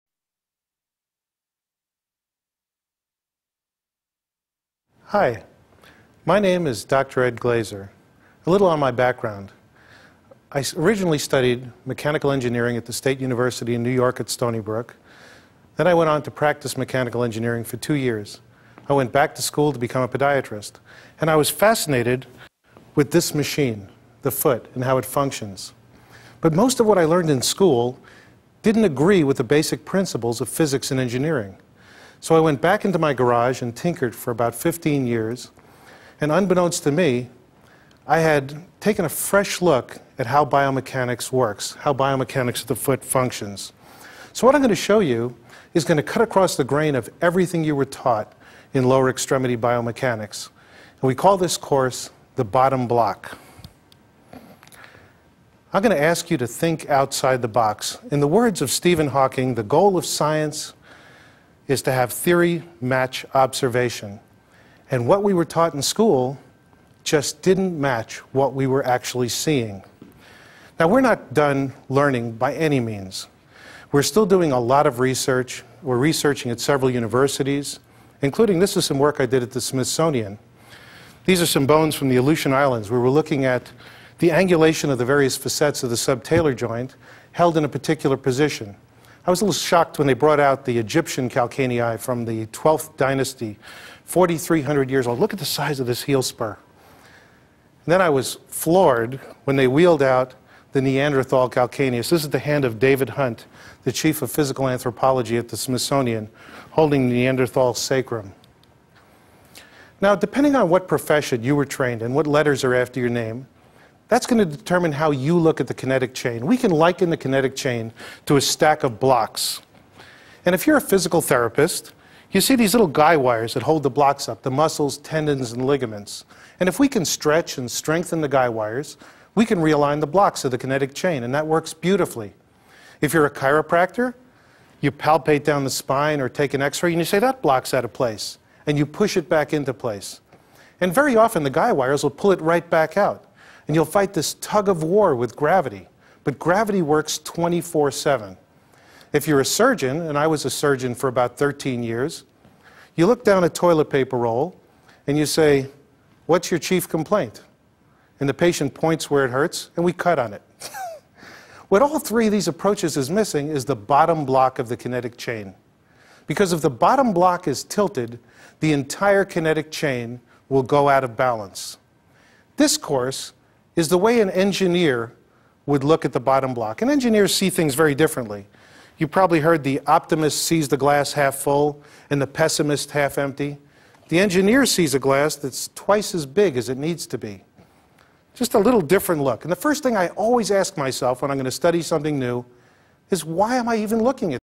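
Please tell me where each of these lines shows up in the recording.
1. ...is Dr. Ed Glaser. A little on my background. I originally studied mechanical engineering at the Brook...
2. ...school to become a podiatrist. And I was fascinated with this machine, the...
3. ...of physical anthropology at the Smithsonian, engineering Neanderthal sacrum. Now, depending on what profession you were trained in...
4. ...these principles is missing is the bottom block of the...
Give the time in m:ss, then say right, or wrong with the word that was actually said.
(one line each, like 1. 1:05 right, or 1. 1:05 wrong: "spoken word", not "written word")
1. 0:06 wrong: "State", not "Brook"
2. 0:19 right
3. 1:44 wrong: "holding", not "engineering"
4. 2:42 wrong: "approaches", not "principles".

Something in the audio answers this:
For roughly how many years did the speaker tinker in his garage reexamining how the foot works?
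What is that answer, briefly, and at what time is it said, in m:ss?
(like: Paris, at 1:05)
15 years, at 0:34.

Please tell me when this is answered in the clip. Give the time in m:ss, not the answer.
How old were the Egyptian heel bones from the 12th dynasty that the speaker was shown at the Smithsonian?
1:34.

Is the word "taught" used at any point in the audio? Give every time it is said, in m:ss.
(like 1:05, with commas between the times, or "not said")
0:47, 1:05.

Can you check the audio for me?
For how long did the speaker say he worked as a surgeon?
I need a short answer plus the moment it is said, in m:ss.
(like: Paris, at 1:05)
13 years, at 2:31.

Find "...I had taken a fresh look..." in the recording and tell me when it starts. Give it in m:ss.
0:38.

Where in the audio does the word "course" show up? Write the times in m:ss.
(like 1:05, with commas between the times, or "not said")
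0:51, 2:52.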